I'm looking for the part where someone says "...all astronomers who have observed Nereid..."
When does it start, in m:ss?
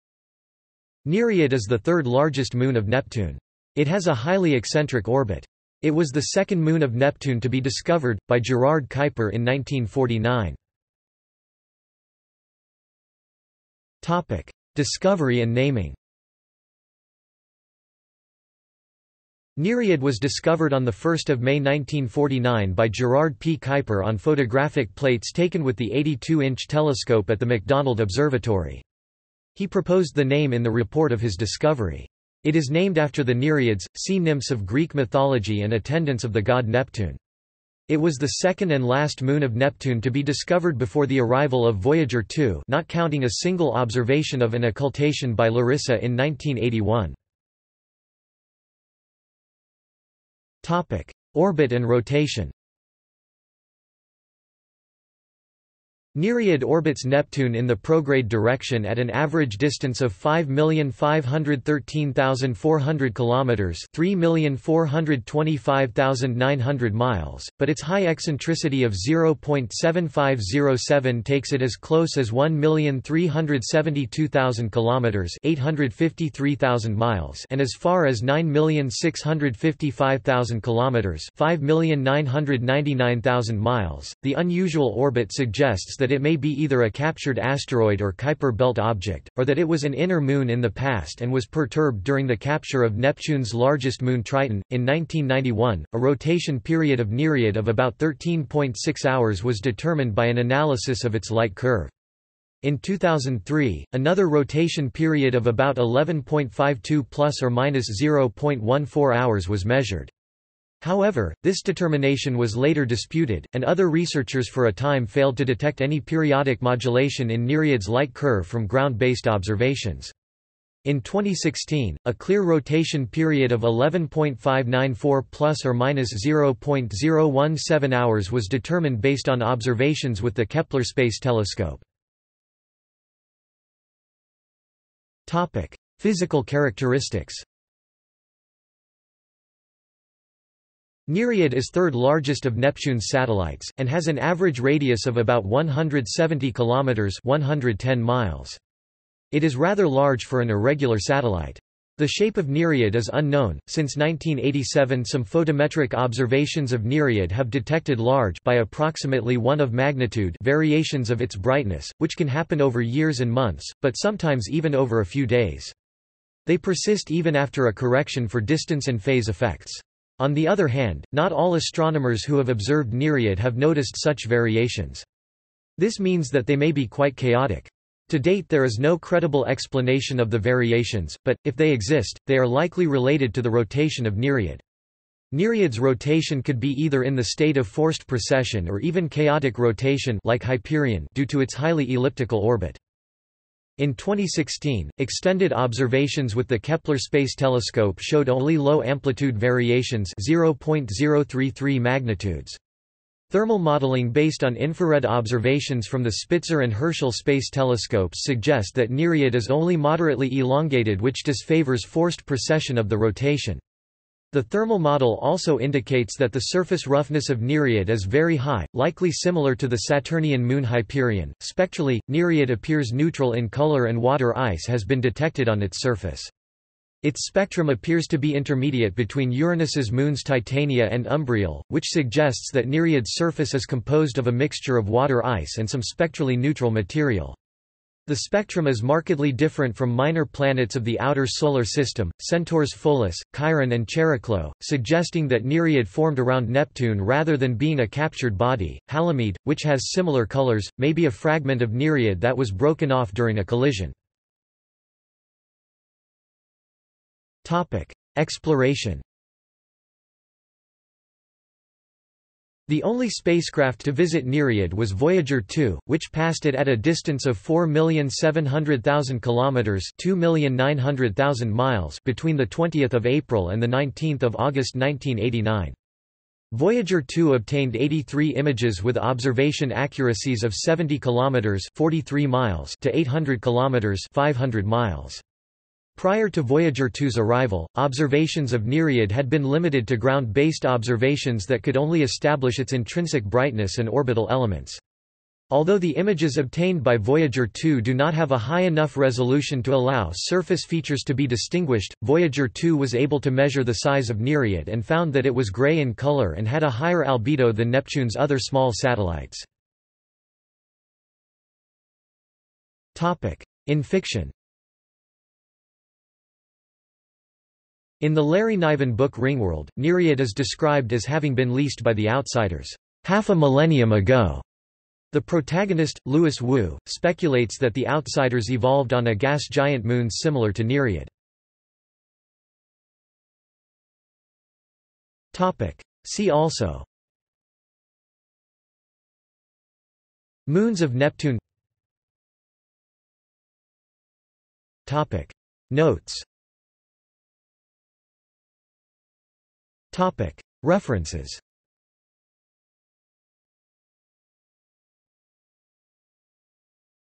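2:51.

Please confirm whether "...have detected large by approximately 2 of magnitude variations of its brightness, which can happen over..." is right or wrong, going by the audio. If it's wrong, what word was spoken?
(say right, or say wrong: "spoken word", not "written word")
wrong: "1", not "2".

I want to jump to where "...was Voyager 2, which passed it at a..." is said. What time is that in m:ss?
4:24.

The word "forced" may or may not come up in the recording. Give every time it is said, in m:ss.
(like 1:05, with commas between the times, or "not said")
3:07, 3:31.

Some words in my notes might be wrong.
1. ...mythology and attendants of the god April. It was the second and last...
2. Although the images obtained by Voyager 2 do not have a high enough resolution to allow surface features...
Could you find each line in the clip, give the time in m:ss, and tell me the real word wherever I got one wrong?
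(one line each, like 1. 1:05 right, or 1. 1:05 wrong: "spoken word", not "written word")
1. 0:34 wrong: "Neptune", not "April"
2. 4:55 right.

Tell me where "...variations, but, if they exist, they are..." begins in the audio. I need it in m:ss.
3:00.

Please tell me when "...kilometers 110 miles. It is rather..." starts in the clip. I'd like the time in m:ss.
2:26.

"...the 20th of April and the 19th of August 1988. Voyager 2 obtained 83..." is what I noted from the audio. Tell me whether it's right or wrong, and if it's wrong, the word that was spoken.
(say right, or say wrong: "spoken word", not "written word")
wrong: "1989", not "1988".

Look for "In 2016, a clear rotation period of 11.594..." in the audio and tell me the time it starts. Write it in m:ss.
2:00.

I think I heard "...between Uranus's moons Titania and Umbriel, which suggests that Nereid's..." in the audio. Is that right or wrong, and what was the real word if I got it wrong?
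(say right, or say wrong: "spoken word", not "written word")
right.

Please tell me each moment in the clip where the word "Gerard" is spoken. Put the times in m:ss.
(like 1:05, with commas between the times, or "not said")
0:08, 0:22.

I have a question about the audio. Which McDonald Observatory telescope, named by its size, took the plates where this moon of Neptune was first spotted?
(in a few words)
82-inch telescope.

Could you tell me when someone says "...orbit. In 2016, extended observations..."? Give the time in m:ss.
3:12.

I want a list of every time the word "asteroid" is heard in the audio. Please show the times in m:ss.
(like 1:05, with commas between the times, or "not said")
1:27.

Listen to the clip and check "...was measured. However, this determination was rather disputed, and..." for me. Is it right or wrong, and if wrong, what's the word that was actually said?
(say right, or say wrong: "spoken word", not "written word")
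wrong: "later", not "rather".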